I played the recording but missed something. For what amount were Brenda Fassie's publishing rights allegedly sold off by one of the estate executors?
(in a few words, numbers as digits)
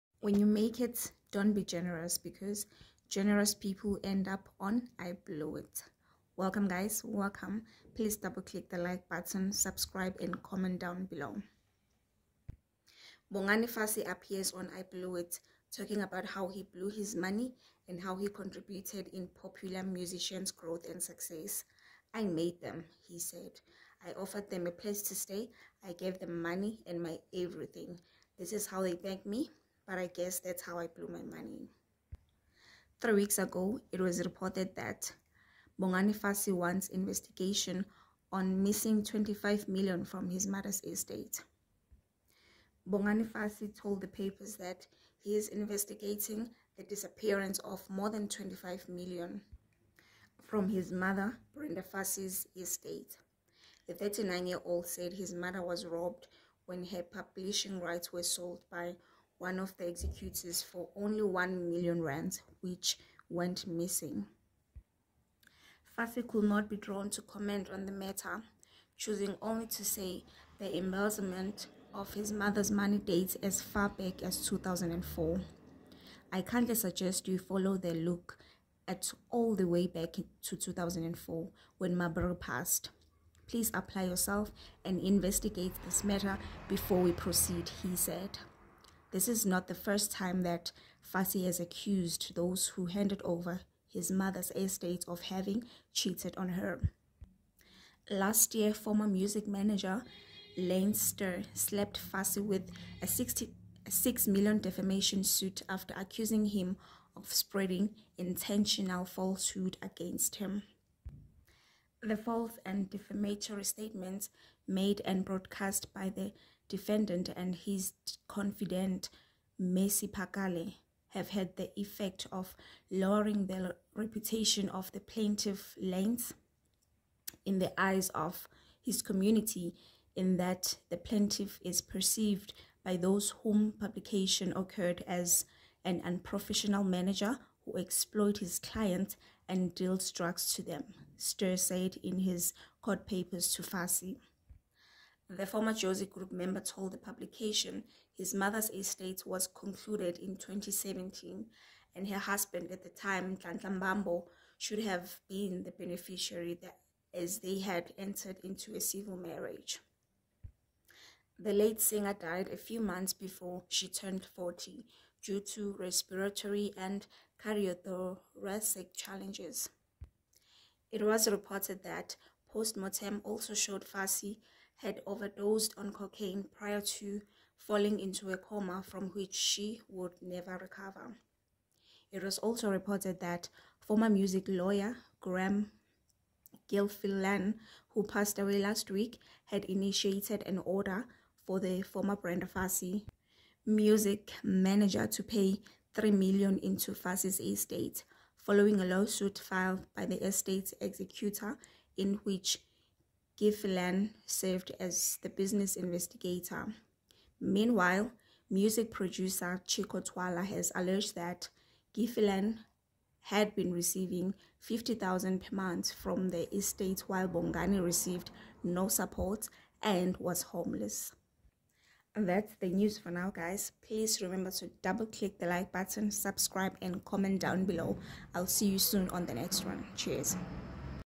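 1 million rands.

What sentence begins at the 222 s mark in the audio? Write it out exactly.
And that's the news for now, guys.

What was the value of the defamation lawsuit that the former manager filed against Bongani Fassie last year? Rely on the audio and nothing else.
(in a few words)
66 million.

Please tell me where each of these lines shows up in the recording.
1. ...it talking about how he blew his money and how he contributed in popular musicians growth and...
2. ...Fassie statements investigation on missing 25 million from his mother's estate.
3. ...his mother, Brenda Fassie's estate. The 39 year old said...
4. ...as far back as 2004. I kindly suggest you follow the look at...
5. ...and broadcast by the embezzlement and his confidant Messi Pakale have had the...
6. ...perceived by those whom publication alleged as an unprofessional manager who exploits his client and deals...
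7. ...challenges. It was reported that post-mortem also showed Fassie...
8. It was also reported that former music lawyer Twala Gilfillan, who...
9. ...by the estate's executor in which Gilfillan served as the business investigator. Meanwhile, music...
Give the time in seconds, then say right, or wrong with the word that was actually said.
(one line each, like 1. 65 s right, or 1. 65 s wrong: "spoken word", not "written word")
1. 15 s right
2. 36 s wrong: "wants", not "statements"
3. 50 s right
4. 73 s right
5. 115 s wrong: "defendant", not "embezzlement"
6. 131 s wrong: "occurred", not "alleged"
7. 168 s right
8. 182 s wrong: "Graham", not "Twala"
9. 199 s right.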